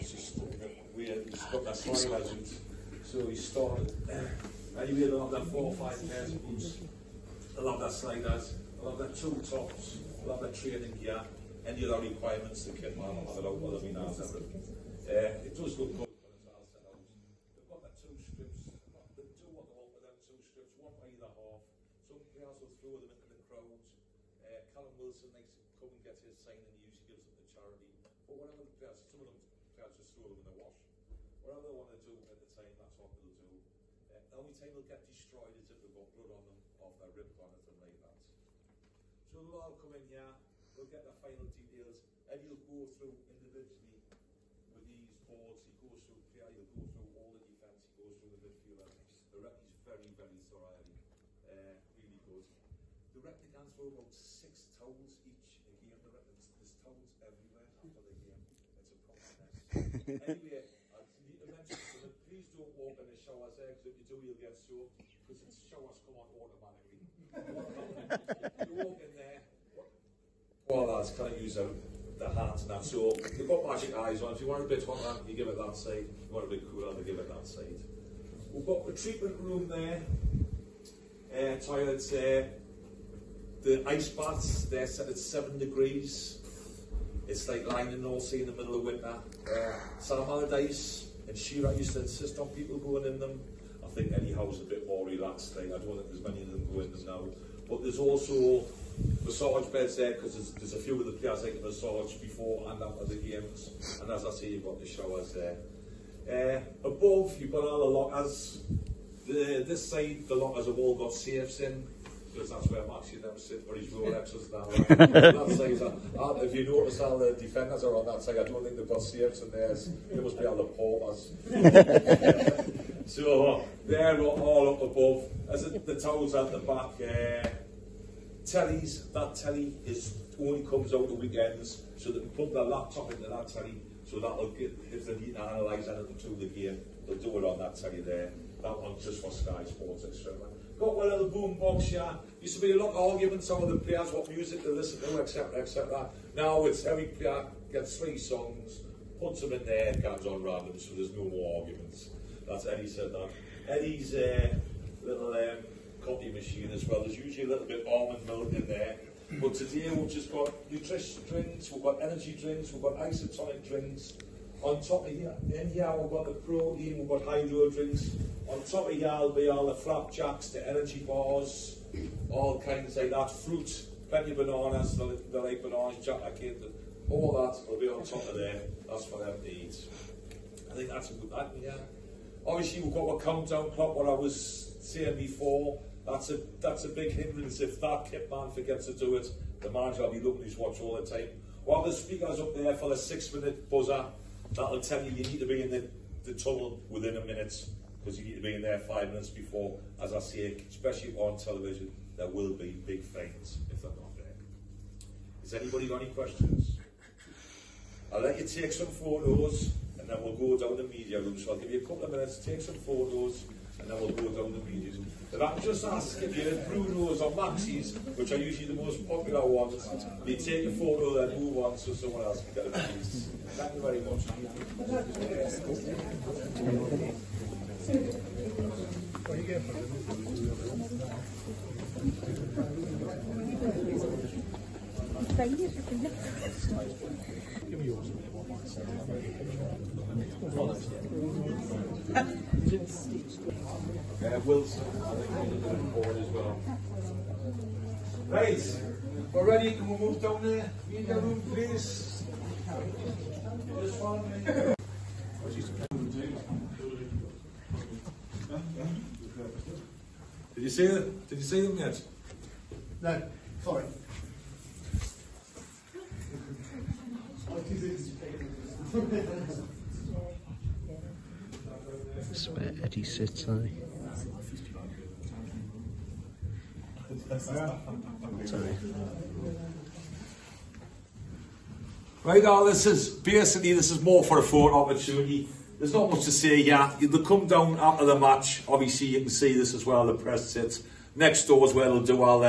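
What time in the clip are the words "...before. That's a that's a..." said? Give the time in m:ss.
3:05.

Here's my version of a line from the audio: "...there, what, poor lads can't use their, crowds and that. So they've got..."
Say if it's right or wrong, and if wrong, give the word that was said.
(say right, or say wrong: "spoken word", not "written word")
wrong: "hands", not "crowds".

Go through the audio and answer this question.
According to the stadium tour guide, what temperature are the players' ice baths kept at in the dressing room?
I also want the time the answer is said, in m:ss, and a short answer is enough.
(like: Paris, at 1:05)
7 degrees, at 1:25.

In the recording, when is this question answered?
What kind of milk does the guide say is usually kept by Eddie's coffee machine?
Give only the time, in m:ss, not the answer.
2:37.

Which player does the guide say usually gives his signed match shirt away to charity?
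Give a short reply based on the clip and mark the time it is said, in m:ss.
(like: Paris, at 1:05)
Callum Wilson, at 0:24.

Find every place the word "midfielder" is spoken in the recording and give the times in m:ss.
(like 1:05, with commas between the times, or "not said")
0:48.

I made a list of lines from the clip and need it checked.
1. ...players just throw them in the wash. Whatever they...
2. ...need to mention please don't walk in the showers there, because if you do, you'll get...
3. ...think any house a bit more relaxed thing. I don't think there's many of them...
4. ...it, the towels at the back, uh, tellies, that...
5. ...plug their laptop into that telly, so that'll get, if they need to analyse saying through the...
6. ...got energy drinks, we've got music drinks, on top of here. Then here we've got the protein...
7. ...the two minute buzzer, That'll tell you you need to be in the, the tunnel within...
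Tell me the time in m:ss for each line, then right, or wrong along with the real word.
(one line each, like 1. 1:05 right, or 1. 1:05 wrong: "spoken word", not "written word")
1. 0:29 right
2. 1:01 right
3. 1:33 right
4. 2:05 right
5. 2:12 wrong: "anything", not "saying"
6. 2:41 wrong: "isotonic", not "music"
7. 3:12 wrong: "six", not "two".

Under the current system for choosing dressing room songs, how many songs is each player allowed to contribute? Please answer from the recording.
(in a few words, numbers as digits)
3.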